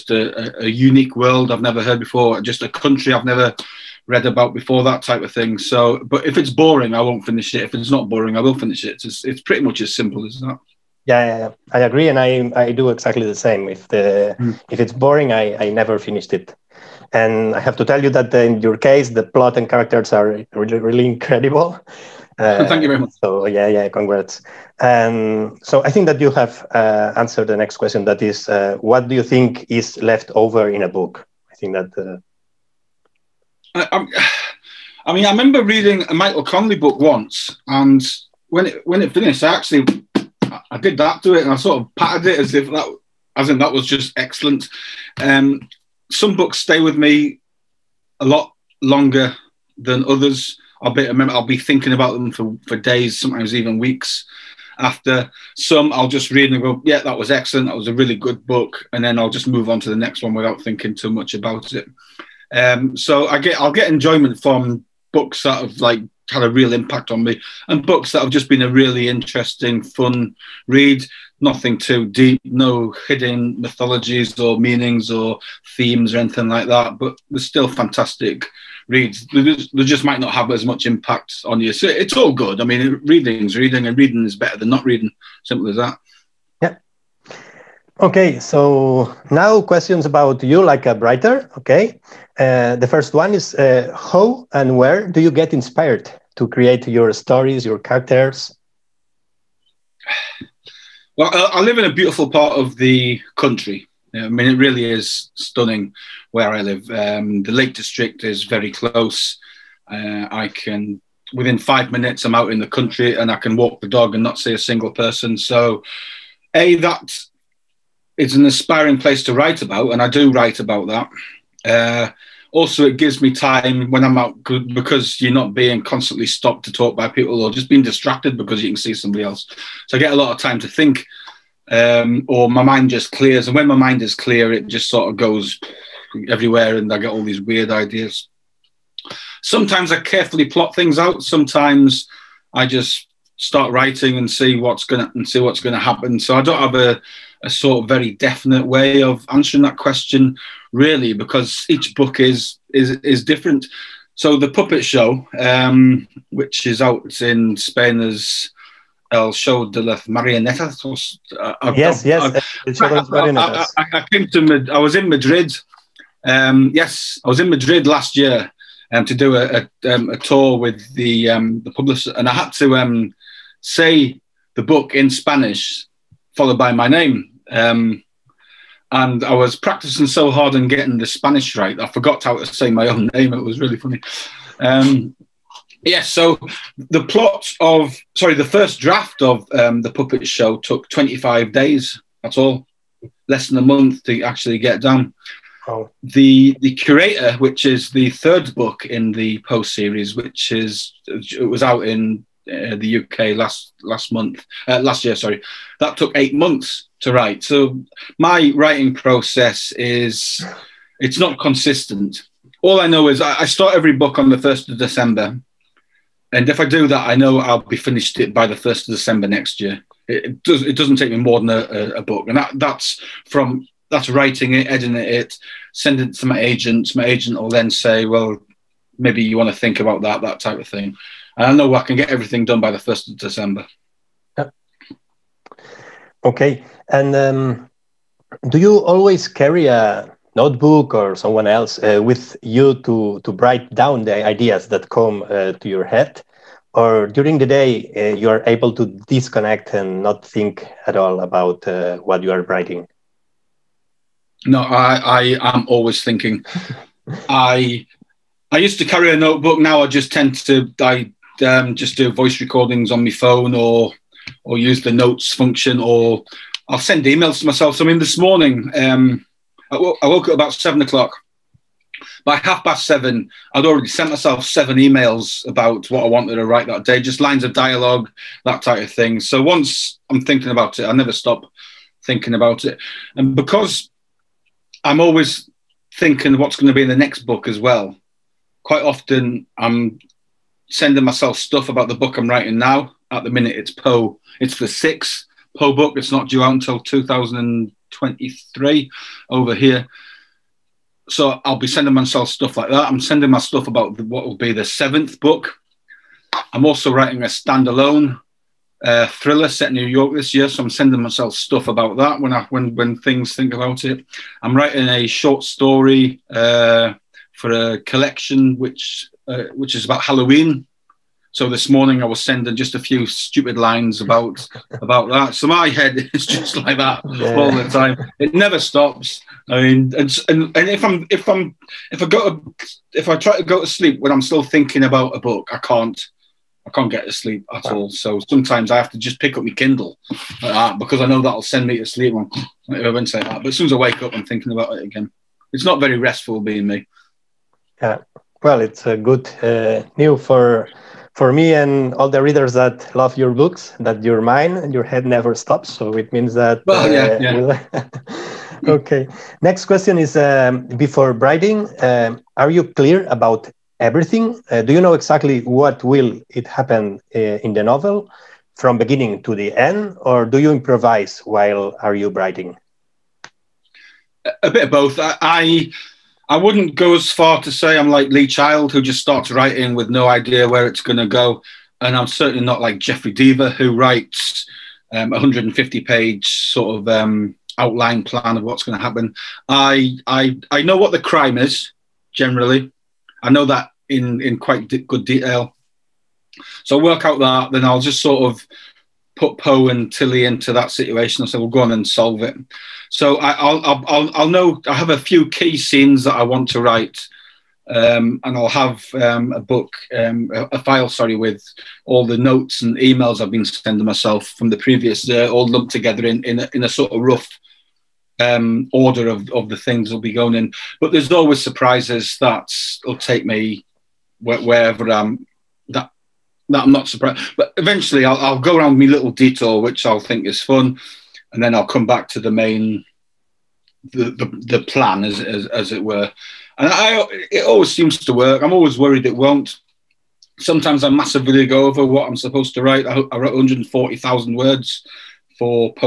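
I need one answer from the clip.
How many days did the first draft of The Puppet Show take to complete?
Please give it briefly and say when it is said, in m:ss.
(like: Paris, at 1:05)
25, at 3:10.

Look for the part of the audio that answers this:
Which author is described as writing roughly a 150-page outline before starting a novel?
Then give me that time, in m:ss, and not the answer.
6:22.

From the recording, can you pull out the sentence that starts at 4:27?
So I mean, this morning um, I woke up about seven o'clock.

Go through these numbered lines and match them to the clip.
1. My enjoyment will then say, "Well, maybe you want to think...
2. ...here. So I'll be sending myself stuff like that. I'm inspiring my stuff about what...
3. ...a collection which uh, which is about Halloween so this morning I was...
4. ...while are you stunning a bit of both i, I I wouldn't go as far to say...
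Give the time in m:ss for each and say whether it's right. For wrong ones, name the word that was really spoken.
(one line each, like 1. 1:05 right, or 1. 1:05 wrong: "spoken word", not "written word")
1. 3:46 wrong: "agent", not "enjoyment"
2. 4:59 wrong: "sending", not "inspiring"
3. 5:17 right
4. 6:11 wrong: "writing", not "stunning".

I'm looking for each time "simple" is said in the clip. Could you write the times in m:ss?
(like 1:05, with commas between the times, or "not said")
0:09, 1:25.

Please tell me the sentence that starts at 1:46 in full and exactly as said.
Um, the Lake District is very close.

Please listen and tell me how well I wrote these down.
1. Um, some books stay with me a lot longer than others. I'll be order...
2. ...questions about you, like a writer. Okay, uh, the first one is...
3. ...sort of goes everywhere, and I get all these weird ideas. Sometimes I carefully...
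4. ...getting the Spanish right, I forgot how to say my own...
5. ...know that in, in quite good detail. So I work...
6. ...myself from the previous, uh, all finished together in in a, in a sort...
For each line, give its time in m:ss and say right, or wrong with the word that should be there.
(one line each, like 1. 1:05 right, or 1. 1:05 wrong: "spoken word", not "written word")
1. 0:45 wrong: "remember", not "order"
2. 1:29 right
3. 2:14 right
4. 3:00 right
5. 6:33 right
6. 6:53 wrong: "lumped", not "finished".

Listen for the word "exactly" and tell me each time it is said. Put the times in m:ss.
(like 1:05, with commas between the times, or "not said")
0:12, 6:04.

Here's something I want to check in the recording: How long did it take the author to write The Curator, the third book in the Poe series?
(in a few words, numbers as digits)
8 months.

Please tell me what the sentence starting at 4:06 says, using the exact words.
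Or during the day, uh, you are able to disconnect and not think at all about uh, what you are writing.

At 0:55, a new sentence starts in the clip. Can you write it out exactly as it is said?
Some I'll just read and go, yeah, that was excellent.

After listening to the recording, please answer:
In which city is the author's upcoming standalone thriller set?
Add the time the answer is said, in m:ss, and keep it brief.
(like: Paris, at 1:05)
New York, at 5:09.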